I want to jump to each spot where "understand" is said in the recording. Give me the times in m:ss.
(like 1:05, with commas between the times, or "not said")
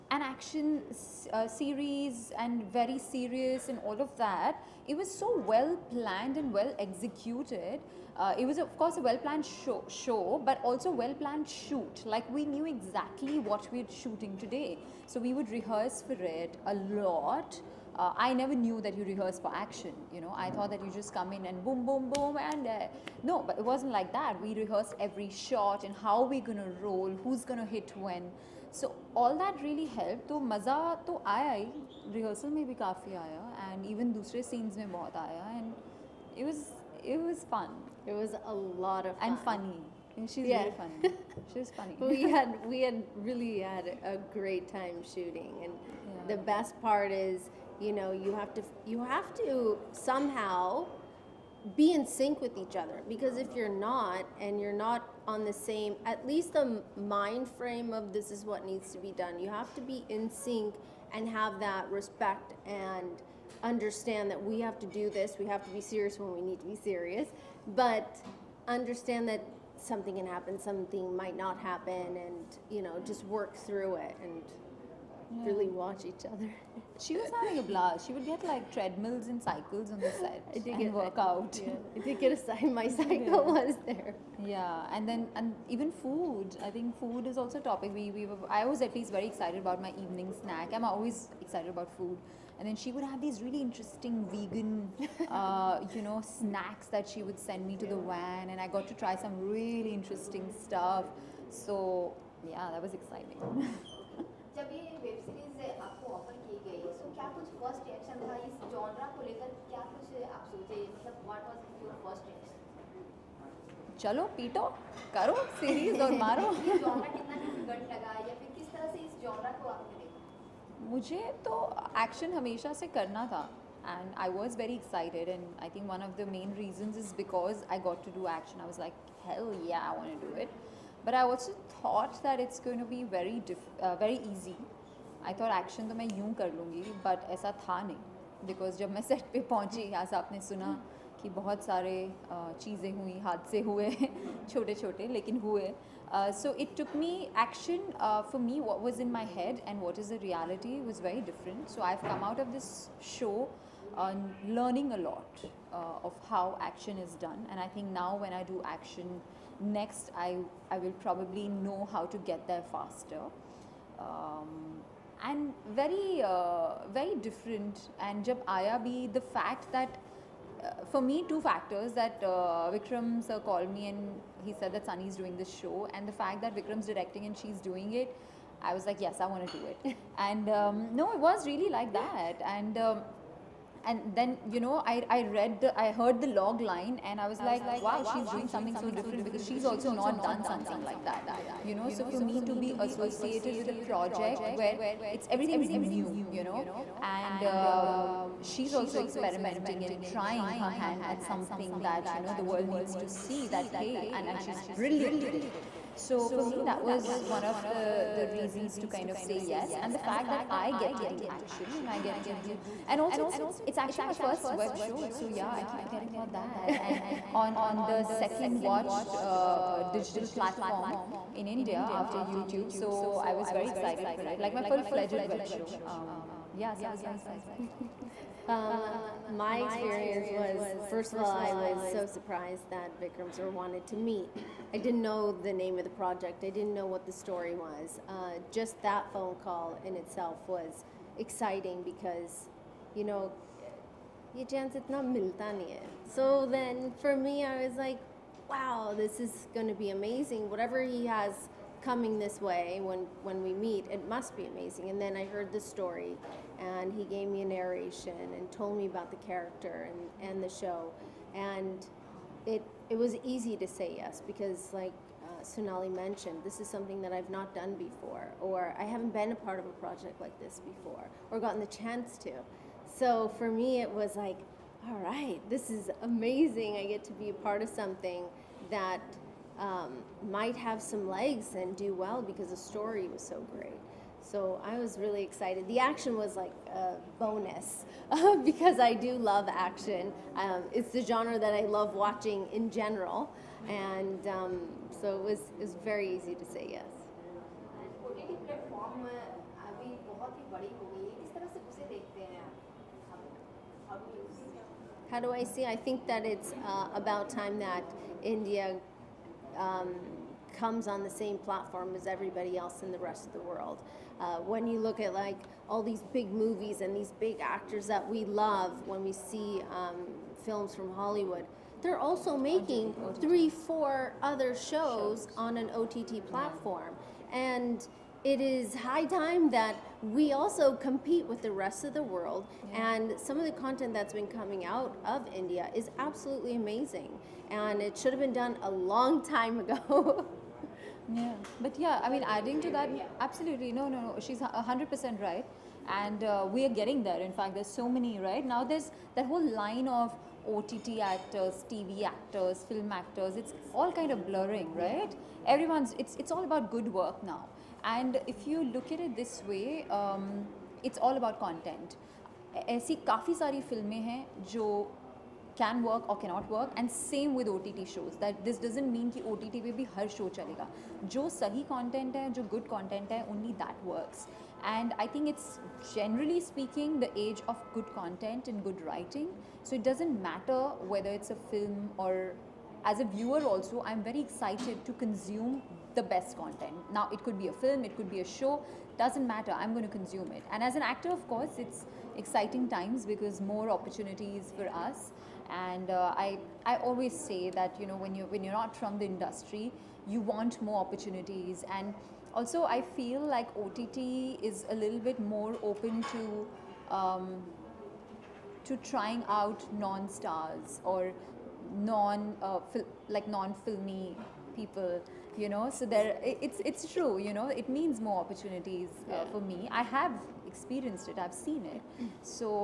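1:03, 1:08.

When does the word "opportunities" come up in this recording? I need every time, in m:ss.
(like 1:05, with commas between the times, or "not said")
6:33, 6:40, 6:58.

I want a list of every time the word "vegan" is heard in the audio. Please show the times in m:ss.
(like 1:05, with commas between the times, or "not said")
1:34.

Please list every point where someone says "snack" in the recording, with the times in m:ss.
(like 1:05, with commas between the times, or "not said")
1:30, 1:36.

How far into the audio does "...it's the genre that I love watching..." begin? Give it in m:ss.
4:50.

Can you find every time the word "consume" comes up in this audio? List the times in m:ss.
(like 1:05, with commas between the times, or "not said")
6:24, 6:29.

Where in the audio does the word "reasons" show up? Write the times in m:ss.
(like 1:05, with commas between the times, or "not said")
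2:06, 3:28.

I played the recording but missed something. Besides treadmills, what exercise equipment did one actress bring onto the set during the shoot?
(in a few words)
Cycles.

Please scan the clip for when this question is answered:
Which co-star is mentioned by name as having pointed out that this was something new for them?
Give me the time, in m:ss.
4:25.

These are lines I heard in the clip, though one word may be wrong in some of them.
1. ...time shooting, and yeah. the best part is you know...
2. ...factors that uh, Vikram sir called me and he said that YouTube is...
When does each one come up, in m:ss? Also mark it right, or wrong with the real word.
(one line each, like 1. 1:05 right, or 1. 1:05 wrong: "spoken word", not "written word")
1. 0:44 right
2. 2:51 wrong: "Sunny", not "YouTube".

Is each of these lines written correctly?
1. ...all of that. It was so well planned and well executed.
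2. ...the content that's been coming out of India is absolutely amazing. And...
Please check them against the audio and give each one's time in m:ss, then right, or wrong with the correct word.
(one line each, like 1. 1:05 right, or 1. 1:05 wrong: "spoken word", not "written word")
1. 0:03 right
2. 5:33 right.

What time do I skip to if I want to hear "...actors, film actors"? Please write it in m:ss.
5:52.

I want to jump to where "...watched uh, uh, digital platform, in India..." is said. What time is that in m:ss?
3:38.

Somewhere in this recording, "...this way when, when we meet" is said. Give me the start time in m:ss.
4:12.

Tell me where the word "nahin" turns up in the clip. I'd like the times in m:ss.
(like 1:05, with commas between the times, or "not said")
2:17.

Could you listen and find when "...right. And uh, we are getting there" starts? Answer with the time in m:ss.
5:45.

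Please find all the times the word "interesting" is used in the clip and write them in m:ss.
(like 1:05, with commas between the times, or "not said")
1:33, 1:39.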